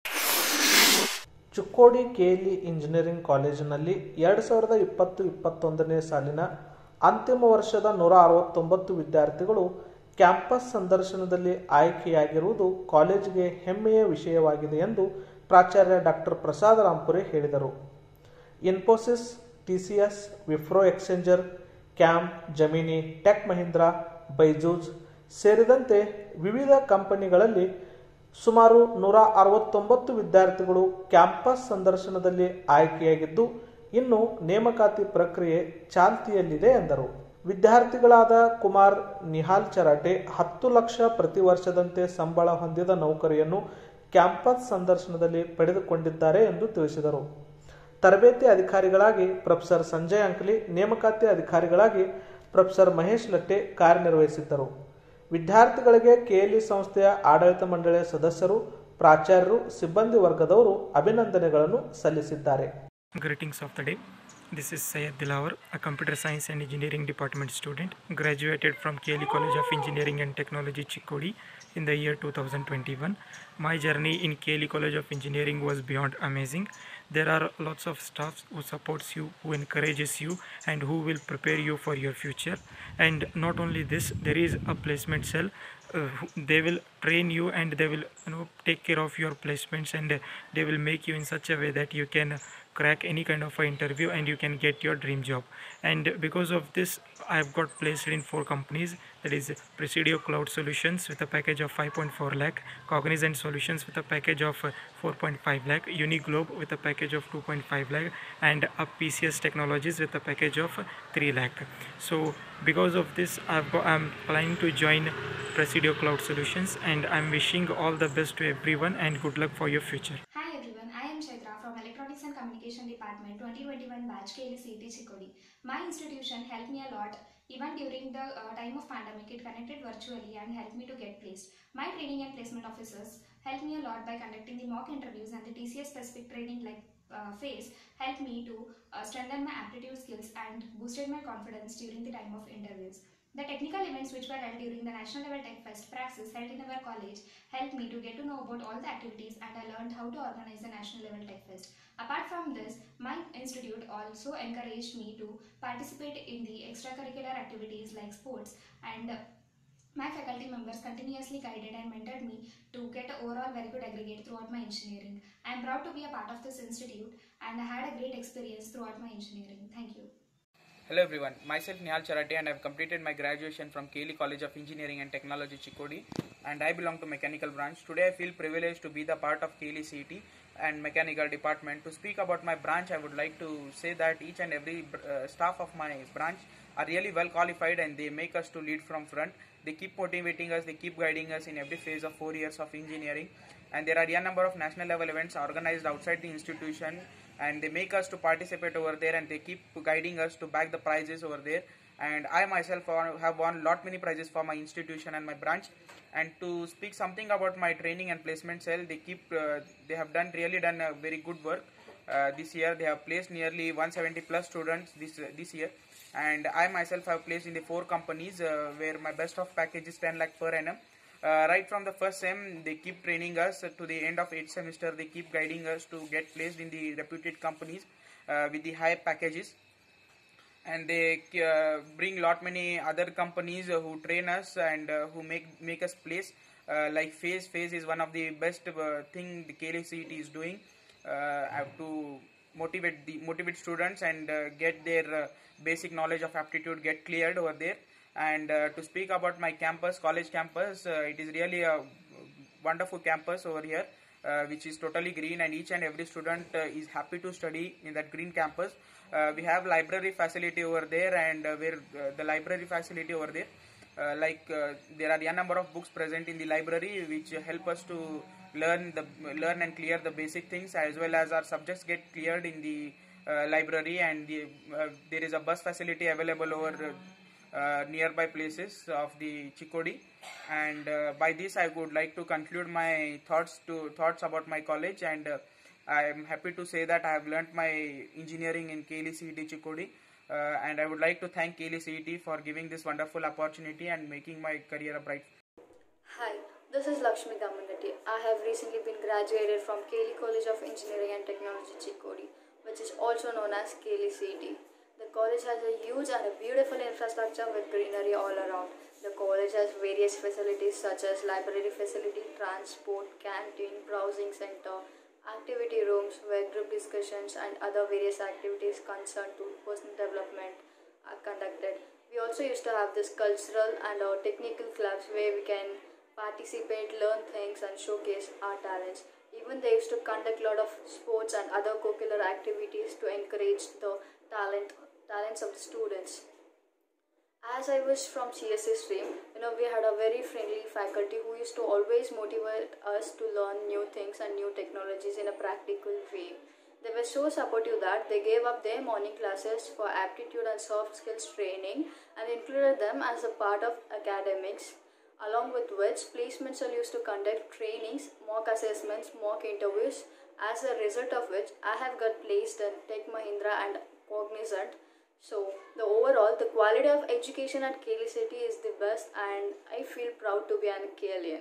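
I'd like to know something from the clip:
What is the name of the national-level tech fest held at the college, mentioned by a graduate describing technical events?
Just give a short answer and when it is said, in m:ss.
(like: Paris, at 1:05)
Praxis, at 2:25.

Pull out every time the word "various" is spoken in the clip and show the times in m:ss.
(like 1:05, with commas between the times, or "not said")
5:09, 5:17.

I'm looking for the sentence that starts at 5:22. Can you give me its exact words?
We also used to have this cultural and our technical clubs where we can participate, learn things and showcase our talents.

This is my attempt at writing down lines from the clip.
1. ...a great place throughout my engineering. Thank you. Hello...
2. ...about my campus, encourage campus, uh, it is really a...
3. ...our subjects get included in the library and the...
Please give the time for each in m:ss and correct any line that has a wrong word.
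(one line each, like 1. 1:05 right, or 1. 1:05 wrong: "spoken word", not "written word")
1. 2:47 wrong: "experience", not "place"
2. 4:09 wrong: "college", not "encourage"
3. 4:31 wrong: "cleared", not "included".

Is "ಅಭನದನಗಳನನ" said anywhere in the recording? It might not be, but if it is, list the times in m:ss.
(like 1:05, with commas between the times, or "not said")
1:01.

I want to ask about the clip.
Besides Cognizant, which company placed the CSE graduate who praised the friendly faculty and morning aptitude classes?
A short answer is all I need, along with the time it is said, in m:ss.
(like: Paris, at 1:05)
Tech Mahindra, at 6:02.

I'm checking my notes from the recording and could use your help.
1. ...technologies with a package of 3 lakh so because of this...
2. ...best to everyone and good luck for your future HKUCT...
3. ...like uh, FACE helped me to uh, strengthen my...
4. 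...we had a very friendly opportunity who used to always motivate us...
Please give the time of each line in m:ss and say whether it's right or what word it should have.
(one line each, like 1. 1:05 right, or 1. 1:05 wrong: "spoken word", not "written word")
1. 1:49 right
2. 1:58 right
3. 2:16 right
4. 5:39 wrong: "faculty", not "opportunity".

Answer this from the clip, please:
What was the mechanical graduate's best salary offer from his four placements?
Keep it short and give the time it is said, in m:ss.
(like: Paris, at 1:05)
10 lakh per annum, at 3:40.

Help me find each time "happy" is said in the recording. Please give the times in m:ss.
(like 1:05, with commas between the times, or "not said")
4:16, 4:46.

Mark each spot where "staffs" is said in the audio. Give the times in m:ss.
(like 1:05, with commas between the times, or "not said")
1:18, 3:05.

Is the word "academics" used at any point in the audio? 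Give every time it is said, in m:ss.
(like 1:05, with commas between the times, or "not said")
5:53.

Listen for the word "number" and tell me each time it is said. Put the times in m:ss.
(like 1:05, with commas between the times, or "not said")
3:14, 4:25.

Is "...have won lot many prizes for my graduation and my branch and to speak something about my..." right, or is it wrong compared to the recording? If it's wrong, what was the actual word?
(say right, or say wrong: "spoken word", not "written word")
wrong: "institution", not "graduation".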